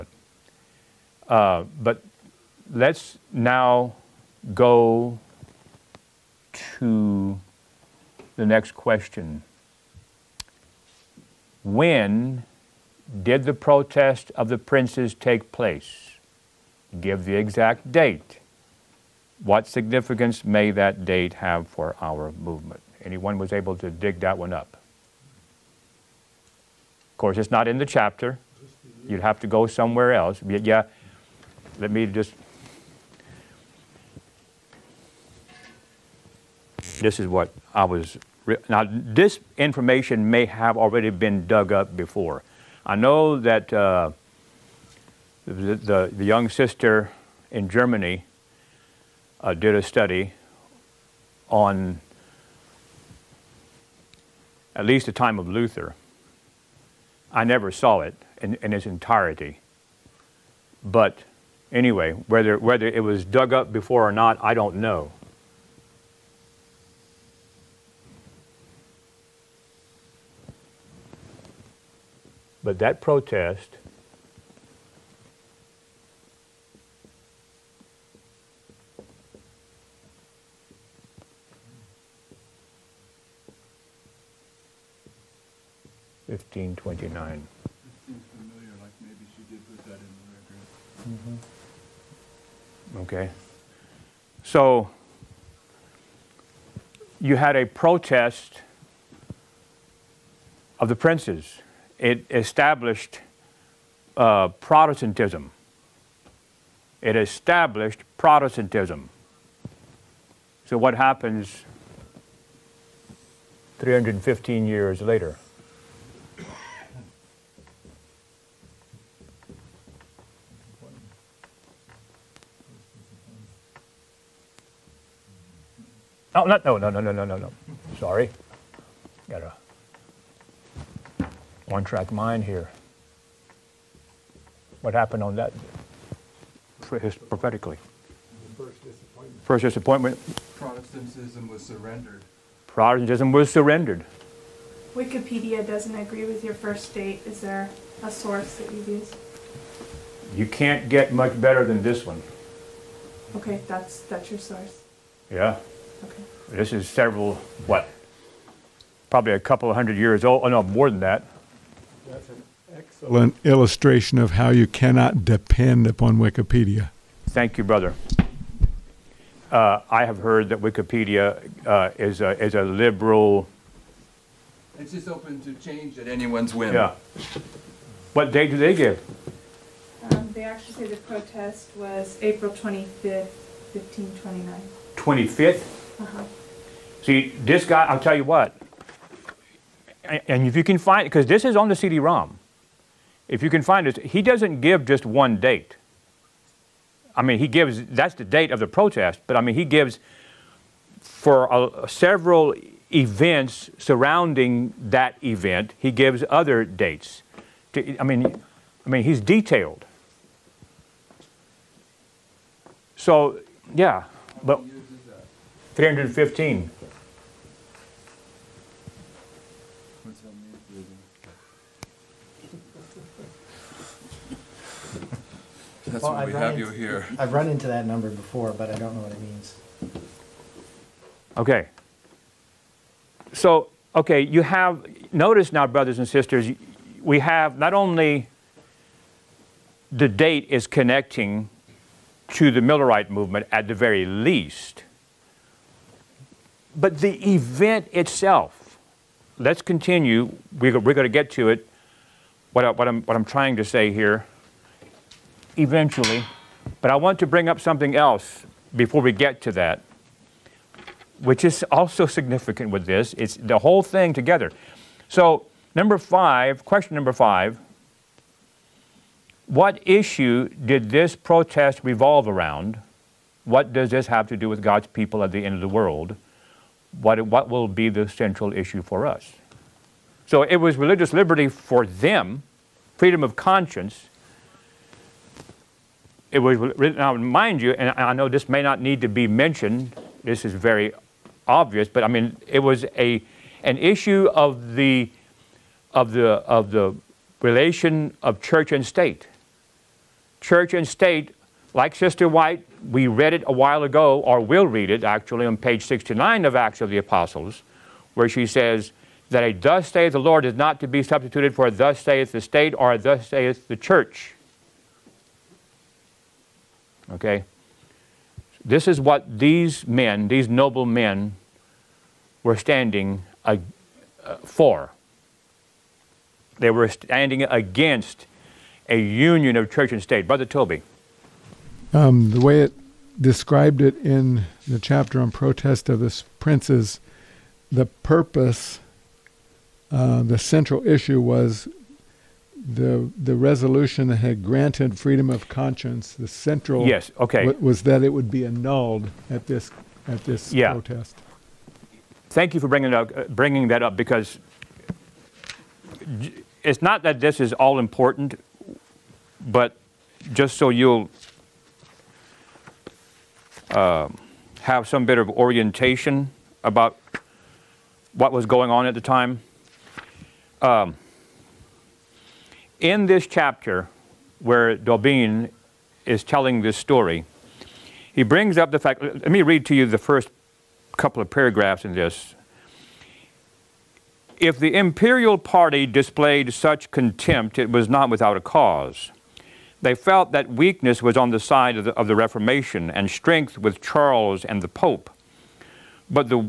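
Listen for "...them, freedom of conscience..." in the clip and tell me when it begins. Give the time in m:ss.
4:41.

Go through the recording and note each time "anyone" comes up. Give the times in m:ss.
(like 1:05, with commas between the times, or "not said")
0:23, 2:56.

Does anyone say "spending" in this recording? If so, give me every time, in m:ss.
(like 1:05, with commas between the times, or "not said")
not said.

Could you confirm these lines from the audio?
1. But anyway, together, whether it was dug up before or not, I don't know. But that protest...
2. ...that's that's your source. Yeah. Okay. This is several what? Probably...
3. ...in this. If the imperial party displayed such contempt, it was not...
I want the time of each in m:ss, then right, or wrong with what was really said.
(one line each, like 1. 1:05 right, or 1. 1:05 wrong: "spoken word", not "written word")
1. 1:00 wrong: "whether", not "together"
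2. 2:33 right
3. 6:21 right.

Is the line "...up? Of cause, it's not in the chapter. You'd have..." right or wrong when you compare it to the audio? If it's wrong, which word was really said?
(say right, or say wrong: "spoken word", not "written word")
wrong: "course", not "cause".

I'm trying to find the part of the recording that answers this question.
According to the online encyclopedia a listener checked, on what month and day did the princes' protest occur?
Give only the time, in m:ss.
3:02.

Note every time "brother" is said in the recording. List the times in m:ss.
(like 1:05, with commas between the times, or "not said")
2:47, 3:55, 5:30.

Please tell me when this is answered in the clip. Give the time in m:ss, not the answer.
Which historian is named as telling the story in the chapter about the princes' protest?
6:14.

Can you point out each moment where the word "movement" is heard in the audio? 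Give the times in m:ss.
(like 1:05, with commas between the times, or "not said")
0:22, 4:03.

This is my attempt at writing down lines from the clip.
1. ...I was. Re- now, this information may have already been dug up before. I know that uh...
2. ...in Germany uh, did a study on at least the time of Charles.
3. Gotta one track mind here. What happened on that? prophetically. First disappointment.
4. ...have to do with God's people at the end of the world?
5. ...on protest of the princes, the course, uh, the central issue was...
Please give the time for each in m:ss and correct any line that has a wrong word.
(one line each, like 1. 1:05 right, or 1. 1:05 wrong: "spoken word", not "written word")
1. 0:37 right
2. 0:47 wrong: "Luther", not "Charles"
3. 2:09 right
4. 4:34 right
5. 5:35 wrong: "purpose", not "course".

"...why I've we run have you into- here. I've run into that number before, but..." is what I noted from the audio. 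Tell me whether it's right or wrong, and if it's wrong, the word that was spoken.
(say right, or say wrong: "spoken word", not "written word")
right.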